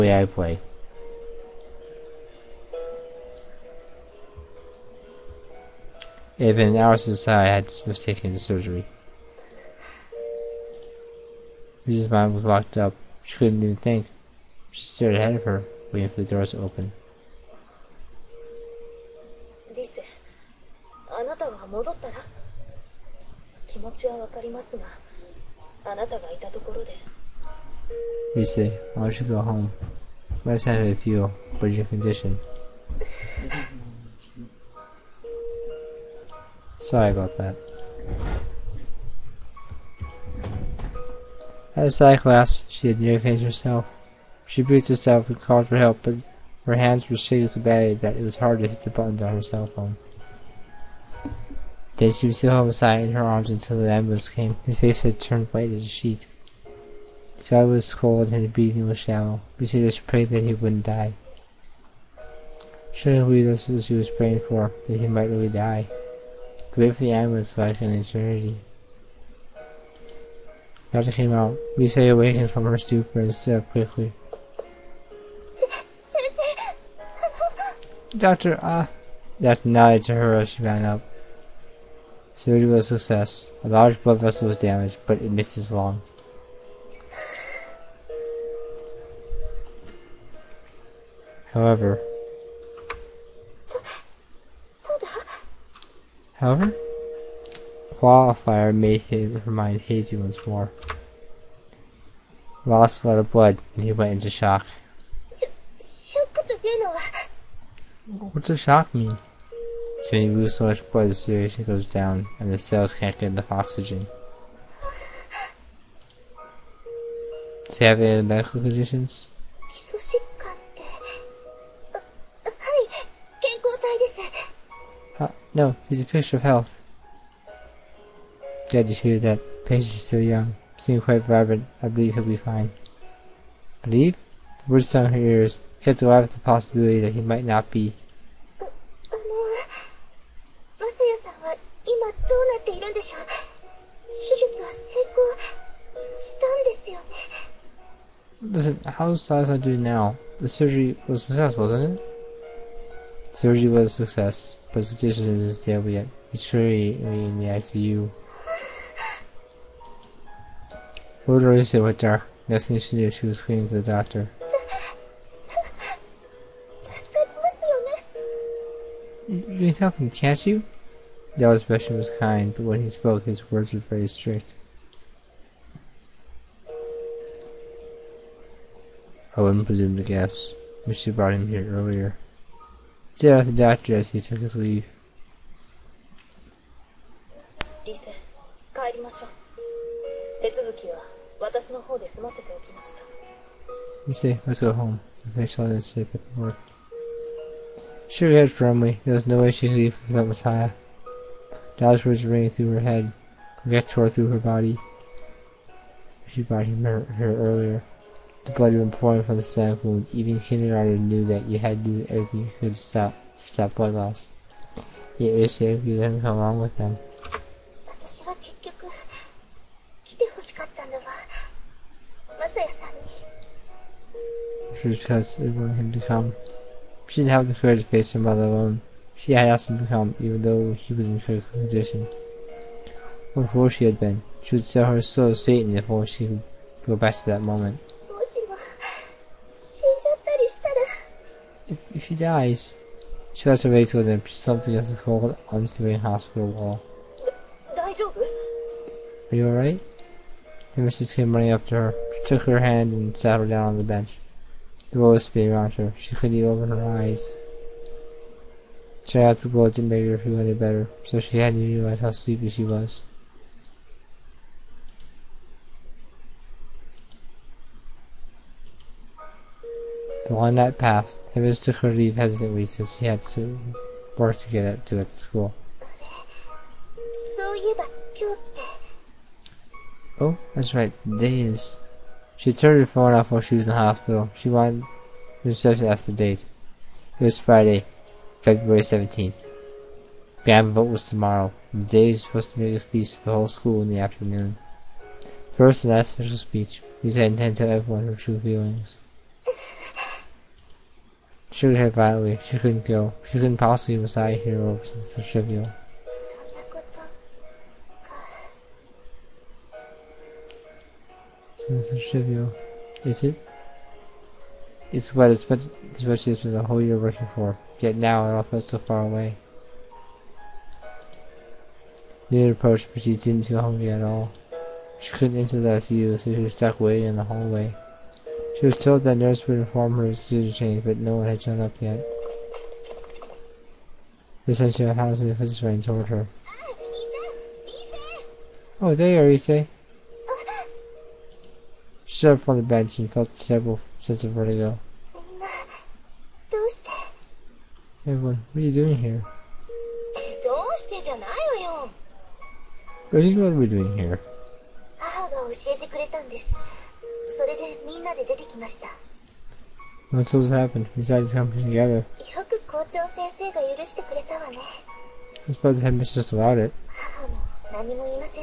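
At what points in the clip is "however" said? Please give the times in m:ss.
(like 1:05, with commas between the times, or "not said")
1:31, 1:36.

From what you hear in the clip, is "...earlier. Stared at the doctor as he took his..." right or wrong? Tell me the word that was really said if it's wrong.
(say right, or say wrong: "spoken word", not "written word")
right.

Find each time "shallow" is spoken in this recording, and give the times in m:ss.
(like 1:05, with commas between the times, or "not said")
0:58.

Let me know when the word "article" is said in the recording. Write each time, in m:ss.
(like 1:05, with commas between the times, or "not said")
not said.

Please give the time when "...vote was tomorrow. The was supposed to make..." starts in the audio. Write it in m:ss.
4:50.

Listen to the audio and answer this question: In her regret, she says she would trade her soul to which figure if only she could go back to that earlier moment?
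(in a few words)
Satan.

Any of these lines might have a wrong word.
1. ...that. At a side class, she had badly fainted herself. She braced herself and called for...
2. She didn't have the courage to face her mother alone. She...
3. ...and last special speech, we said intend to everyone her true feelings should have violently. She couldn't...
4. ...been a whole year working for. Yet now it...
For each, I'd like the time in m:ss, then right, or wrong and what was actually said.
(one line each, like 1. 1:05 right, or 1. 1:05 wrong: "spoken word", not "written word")
1. 0:37 wrong: "nearly", not "badly"
2. 3:47 right
3. 4:55 right
4. 5:16 right.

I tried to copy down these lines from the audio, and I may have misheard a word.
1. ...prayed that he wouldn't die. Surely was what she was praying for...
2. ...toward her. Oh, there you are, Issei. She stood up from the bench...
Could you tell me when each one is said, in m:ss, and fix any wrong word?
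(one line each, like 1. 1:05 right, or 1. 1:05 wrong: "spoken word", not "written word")
1. 1:00 right
2. 5:35 right.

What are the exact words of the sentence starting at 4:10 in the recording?
The missus came running up to her.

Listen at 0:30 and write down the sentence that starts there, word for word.
Life's had a few, but your condition.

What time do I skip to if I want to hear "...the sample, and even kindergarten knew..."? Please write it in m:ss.
3:29.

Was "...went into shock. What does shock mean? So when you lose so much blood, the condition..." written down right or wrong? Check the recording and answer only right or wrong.
wrong.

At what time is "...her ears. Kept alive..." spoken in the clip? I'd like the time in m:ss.
2:15.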